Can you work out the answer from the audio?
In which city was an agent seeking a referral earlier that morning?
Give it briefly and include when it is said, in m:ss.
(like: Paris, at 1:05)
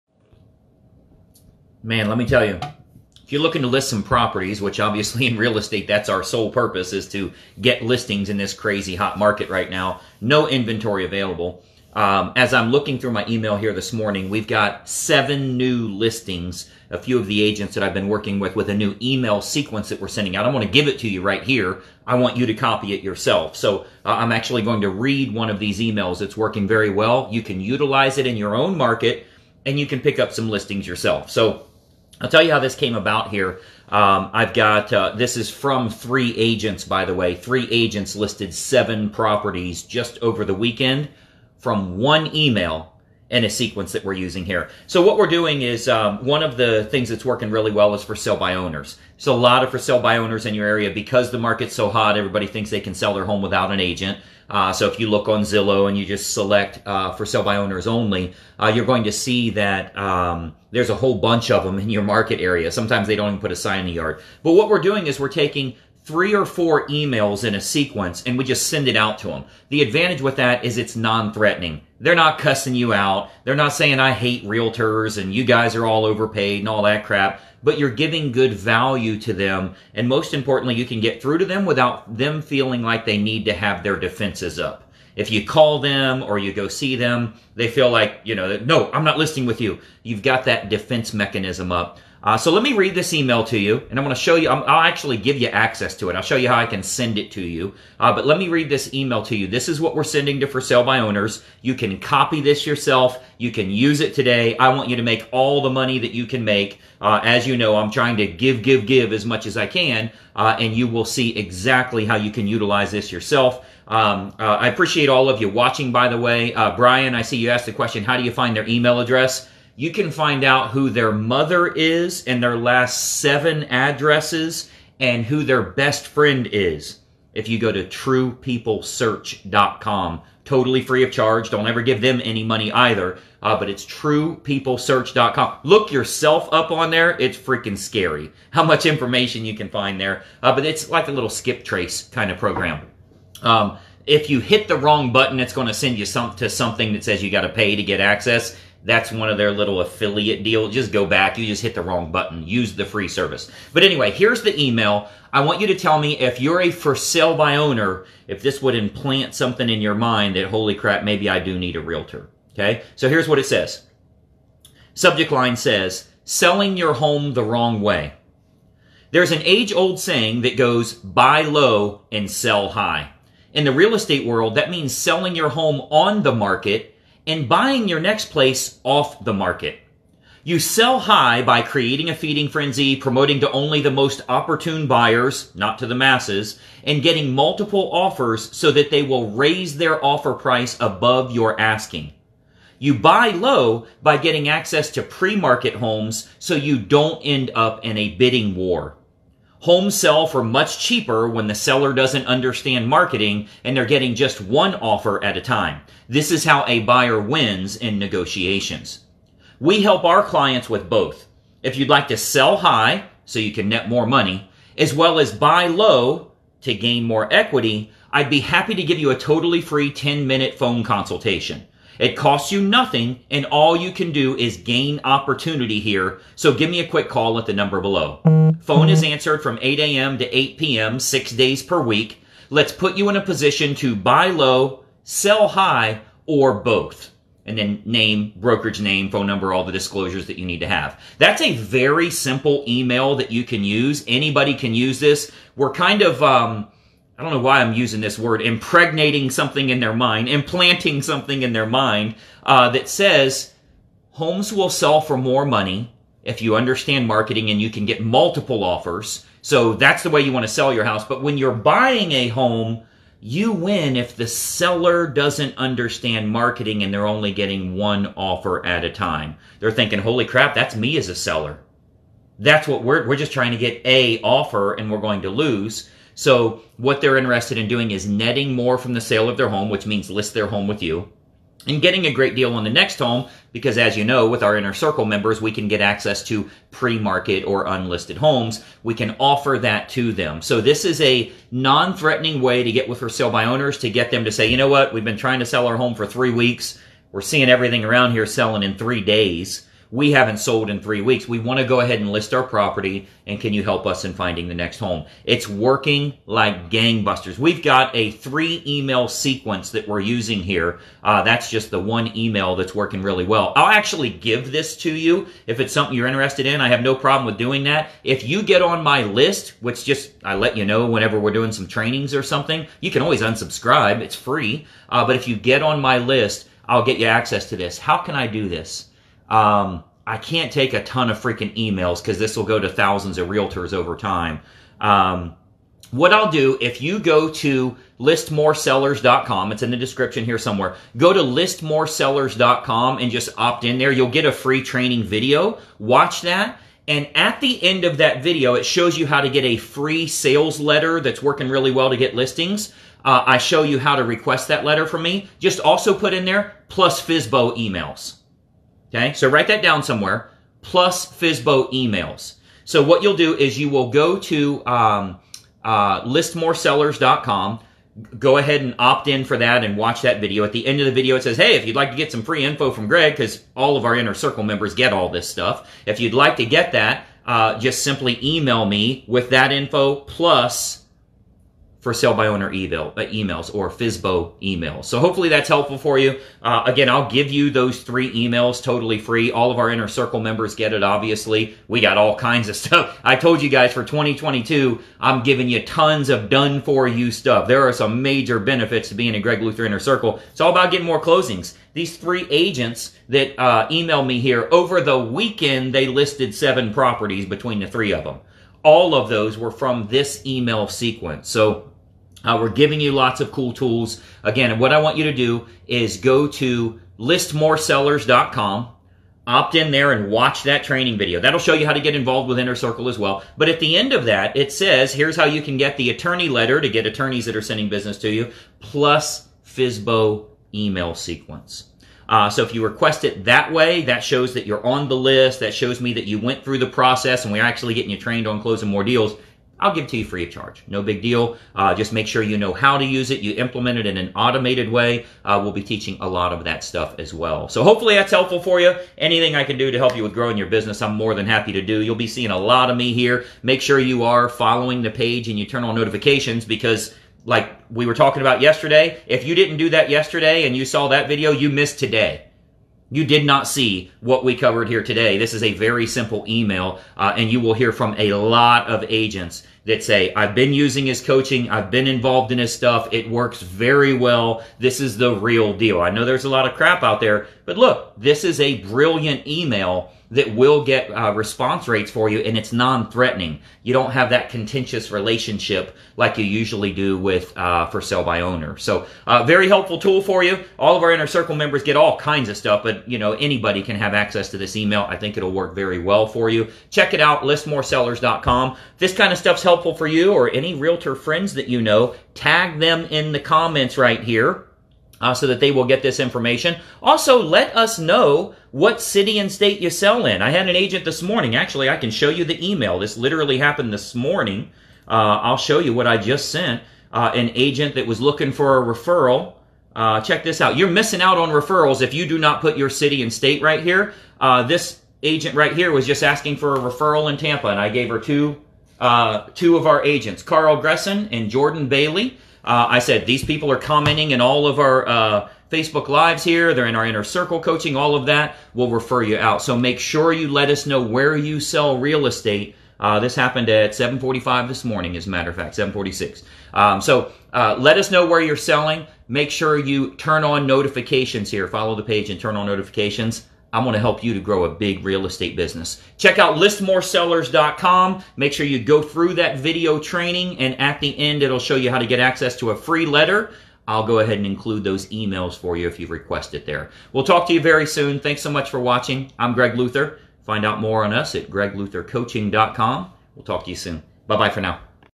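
Tampa, at 8:47.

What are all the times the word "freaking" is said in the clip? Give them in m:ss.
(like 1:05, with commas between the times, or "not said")
2:17, 5:31.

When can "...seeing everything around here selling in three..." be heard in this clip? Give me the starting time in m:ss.
4:57.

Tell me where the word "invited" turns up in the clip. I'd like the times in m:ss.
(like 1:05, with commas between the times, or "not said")
not said.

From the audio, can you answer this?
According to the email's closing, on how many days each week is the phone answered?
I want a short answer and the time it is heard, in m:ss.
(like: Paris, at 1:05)
6, at 3:50.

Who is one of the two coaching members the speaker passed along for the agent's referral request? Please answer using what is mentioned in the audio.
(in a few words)
Carl Gresson.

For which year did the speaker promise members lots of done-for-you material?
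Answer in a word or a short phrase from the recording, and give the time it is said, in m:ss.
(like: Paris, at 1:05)
2022, at 6:33.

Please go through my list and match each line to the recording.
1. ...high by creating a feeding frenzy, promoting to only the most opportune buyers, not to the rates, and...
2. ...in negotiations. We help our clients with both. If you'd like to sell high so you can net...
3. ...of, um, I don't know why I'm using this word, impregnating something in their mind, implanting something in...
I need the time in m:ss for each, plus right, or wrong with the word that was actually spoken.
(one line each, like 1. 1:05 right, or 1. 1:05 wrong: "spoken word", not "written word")
1. 3:00 wrong: "masses", not "rates"
2. 3:27 right
3. 4:06 right.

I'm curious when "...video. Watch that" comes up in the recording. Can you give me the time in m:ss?
5:45.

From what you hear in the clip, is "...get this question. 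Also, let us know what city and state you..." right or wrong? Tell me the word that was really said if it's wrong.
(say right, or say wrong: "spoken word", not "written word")
wrong: "information", not "question".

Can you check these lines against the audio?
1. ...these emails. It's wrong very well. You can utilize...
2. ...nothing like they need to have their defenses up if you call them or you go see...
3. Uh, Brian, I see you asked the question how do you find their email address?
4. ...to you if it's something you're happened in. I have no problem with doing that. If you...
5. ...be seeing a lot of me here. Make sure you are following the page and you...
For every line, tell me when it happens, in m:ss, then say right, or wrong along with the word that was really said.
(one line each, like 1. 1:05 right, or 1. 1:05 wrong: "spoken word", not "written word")
1. 0:25 wrong: "working", not "wrong"
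2. 1:22 wrong: "feeling", not "nothing"
3. 1:56 right
4. 5:14 wrong: "interested", not "happened"
5. 7:31 right.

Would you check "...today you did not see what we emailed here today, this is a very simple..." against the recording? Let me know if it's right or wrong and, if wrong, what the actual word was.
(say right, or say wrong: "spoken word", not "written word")
wrong: "covered", not "emailed".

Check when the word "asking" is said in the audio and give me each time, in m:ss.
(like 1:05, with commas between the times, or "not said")
3:11, 8:46.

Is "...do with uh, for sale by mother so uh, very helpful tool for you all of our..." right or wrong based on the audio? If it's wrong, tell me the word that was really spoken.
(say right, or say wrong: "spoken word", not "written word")
wrong: "owner", not "mother".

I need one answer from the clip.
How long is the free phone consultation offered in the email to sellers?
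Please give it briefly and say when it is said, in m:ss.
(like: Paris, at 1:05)
10 minutes, at 3:39.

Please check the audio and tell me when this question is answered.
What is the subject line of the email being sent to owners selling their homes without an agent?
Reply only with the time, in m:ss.
2:46.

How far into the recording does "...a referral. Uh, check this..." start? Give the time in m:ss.
8:38.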